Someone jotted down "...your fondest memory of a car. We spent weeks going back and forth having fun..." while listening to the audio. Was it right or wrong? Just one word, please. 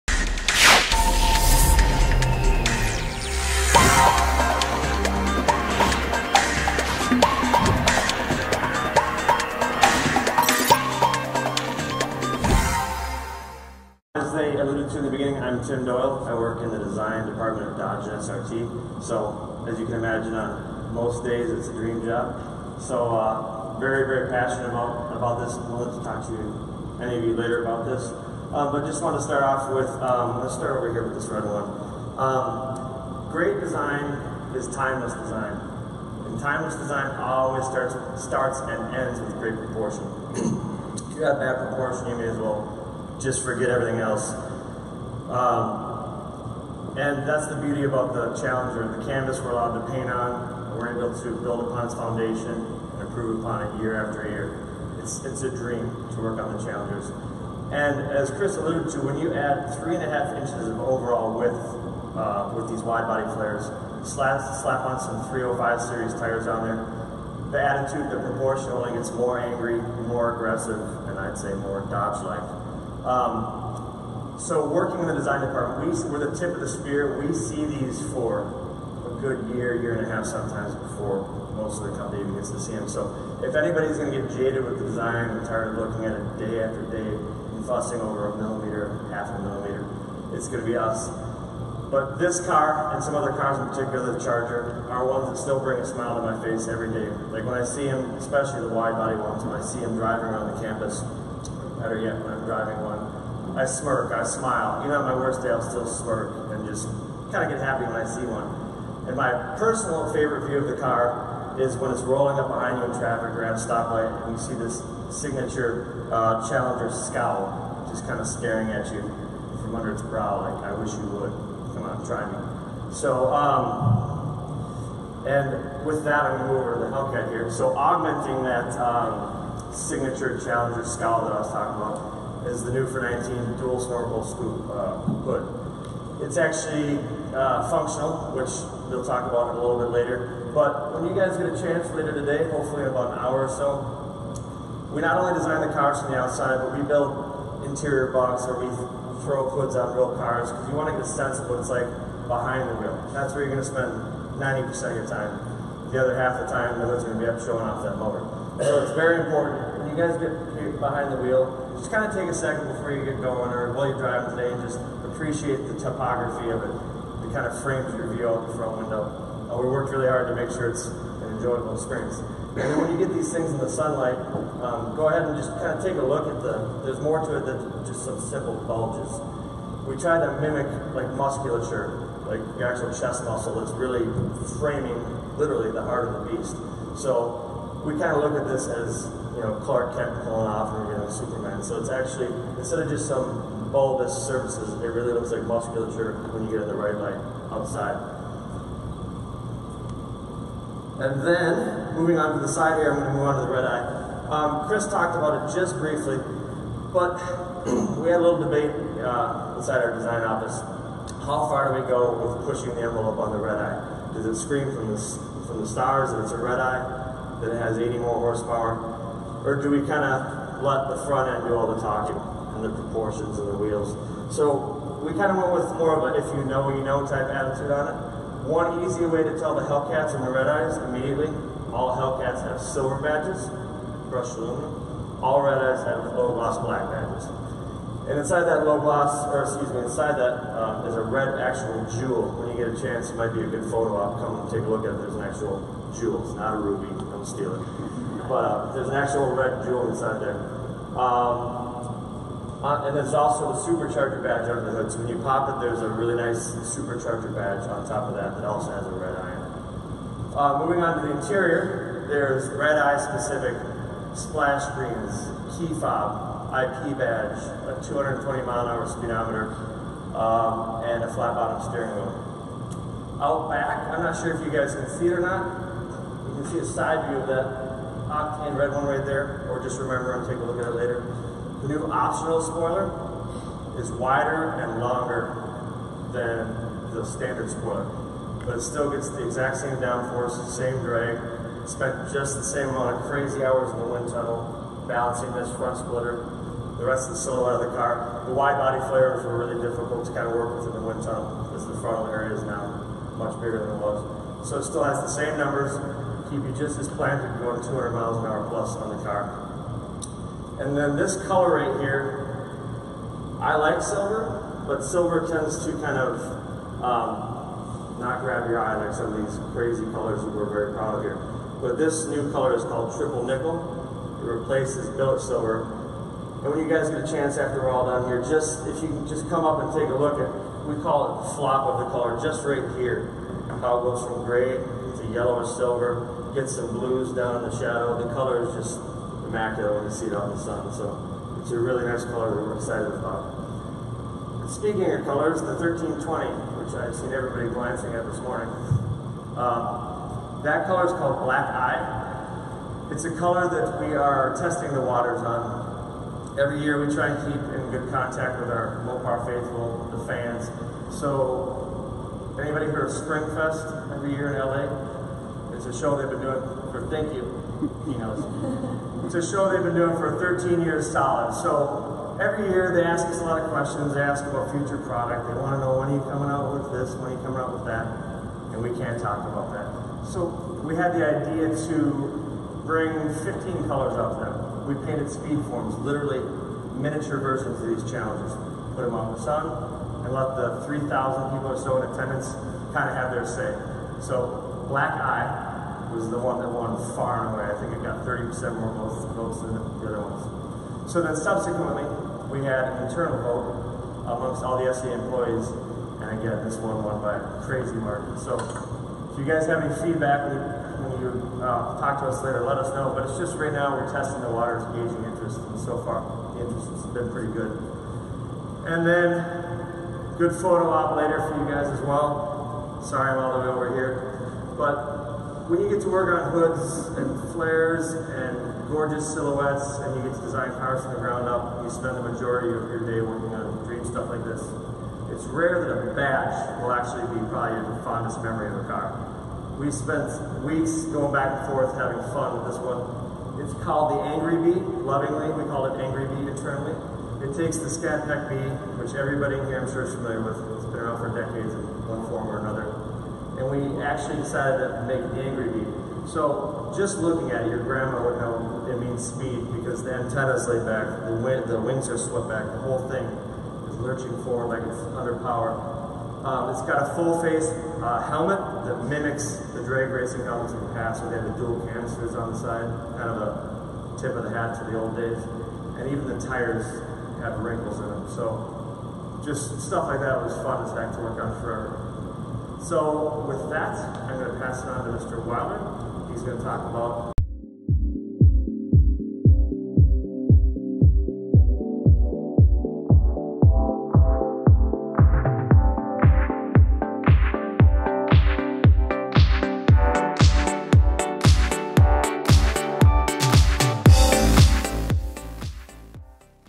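right.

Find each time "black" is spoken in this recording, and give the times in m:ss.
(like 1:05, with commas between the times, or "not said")
3:56, 5:51, 6:34.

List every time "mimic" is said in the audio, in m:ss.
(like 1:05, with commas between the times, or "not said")
3:00, 7:48.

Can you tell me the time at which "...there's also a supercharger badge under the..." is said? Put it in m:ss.
4:12.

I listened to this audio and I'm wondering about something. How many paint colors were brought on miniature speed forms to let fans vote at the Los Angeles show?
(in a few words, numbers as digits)
15.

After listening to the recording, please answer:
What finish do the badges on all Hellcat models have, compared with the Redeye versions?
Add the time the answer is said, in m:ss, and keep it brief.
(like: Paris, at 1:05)
brushed aluminum, at 3:54.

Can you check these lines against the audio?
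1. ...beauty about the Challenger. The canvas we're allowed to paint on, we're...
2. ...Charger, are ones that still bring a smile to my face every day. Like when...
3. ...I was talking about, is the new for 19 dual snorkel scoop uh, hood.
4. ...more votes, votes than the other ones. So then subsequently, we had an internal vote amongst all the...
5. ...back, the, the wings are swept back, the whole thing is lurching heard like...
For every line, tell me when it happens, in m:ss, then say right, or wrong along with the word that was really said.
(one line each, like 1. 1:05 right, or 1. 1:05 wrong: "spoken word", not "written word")
1. 0:47 right
2. 1:34 right
3. 2:11 right
4. 6:38 right
5. 7:40 wrong: "forward", not "heard".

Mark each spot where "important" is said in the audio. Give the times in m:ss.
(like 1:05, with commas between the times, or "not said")
2:39.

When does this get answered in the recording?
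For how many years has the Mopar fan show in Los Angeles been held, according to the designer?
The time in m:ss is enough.
6:10.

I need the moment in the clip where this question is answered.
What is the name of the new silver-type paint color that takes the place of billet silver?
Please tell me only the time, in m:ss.
5:22.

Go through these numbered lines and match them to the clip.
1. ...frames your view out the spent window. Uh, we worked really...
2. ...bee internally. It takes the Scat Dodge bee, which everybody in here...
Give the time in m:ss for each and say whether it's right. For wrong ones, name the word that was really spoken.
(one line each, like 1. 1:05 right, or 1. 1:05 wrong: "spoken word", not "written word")
1. 2:47 wrong: "front", not "spent"
2. 7:26 wrong: "Pack", not "Dodge".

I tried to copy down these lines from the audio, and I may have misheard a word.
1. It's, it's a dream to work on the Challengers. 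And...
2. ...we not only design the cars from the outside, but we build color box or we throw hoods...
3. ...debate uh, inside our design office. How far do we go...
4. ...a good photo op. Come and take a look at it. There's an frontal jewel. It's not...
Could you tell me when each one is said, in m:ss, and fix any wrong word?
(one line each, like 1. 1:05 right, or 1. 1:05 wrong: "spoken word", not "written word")
1. 0:54 right
2. 2:24 wrong: "interior", not "color"
3. 3:28 right
4. 4:03 wrong: "actual", not "frontal".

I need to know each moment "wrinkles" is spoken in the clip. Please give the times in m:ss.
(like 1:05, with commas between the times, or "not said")
7:57.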